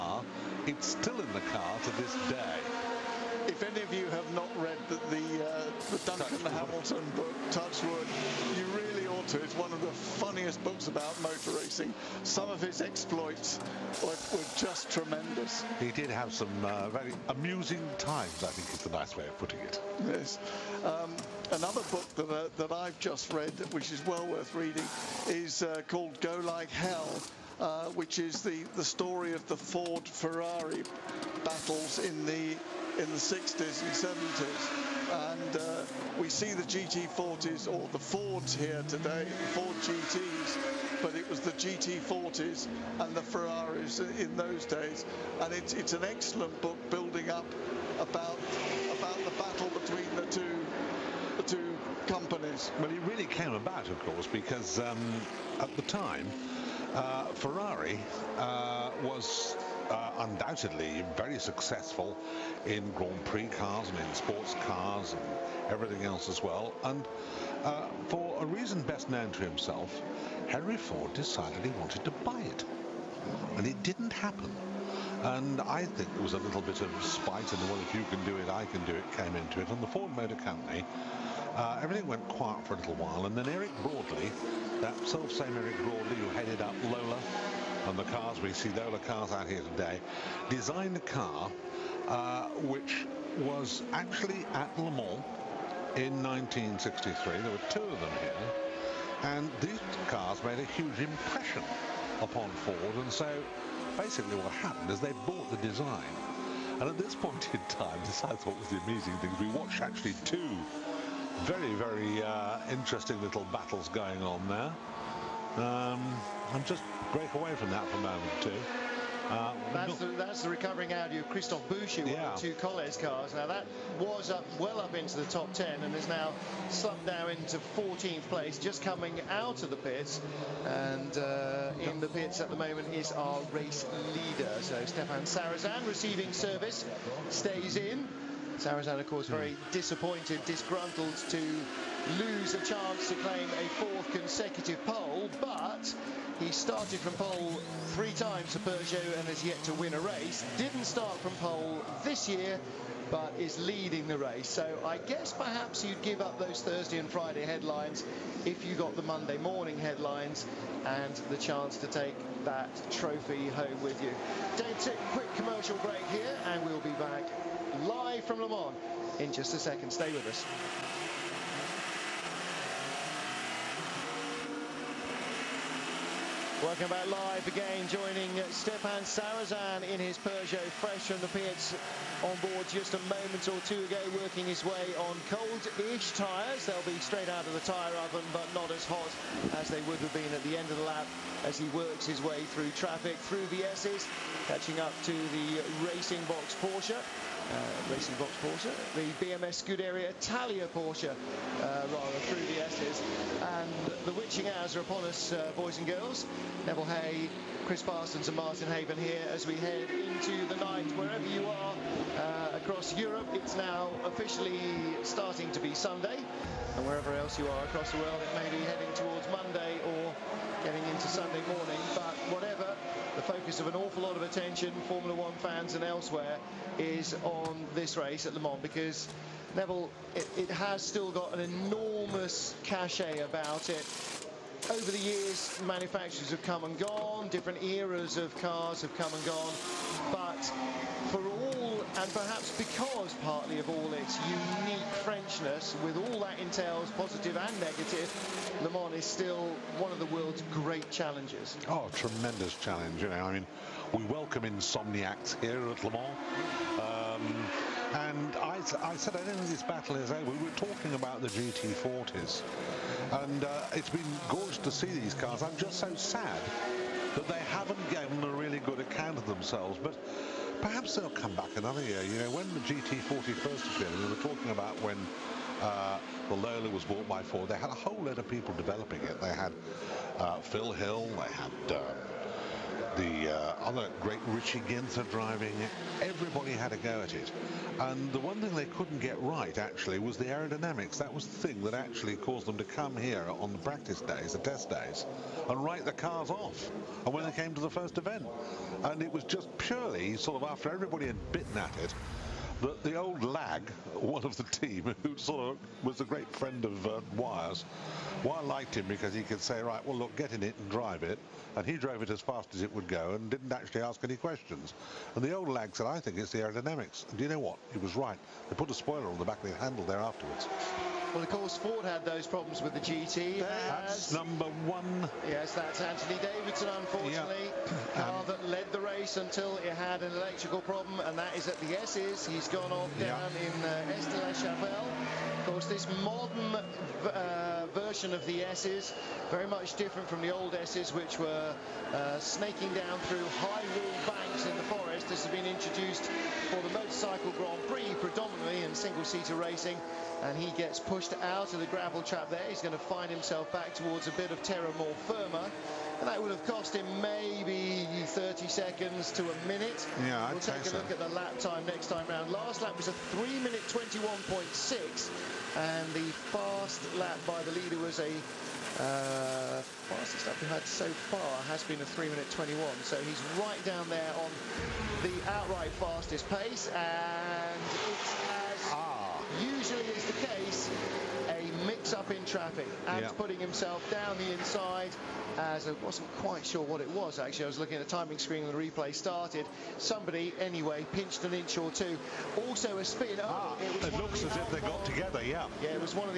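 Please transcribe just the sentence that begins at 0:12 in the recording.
Some of his exploits were, were just tremendous.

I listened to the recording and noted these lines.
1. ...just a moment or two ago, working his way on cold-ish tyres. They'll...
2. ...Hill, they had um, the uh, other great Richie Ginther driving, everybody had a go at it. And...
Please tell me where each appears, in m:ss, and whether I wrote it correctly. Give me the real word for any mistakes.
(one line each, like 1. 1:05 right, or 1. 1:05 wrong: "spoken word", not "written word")
1. 3:02 right
2. 4:40 right.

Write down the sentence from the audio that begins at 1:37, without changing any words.
There were two of them here.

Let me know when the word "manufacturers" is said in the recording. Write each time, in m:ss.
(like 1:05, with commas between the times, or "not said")
3:55.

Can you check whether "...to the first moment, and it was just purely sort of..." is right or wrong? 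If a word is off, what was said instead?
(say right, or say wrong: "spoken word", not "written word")
wrong: "event", not "moment".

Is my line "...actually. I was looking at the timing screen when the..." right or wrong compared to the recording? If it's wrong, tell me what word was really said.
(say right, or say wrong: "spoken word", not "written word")
right.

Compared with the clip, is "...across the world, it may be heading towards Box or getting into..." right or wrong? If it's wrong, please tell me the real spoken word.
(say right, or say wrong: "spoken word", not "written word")
wrong: "Monday", not "Box".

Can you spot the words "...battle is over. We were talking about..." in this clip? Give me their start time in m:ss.
4:19.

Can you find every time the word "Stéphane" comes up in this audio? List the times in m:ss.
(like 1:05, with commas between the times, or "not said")
2:14, 2:58.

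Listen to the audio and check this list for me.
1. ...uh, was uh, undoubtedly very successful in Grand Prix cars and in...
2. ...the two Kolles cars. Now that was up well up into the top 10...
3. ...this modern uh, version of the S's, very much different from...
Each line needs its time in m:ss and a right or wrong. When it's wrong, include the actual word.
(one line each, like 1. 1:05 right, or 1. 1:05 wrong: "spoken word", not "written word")
1. 0:58 right
2. 2:02 right
3. 5:35 right.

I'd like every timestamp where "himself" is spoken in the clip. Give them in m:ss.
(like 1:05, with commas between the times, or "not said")
1:09, 5:53, 6:23.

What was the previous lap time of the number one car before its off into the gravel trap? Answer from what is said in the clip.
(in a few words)
3 minutes 21.6.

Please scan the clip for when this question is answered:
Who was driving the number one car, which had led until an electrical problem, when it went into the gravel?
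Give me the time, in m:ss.
5:25.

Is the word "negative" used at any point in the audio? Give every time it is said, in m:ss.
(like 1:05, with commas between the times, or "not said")
4:07.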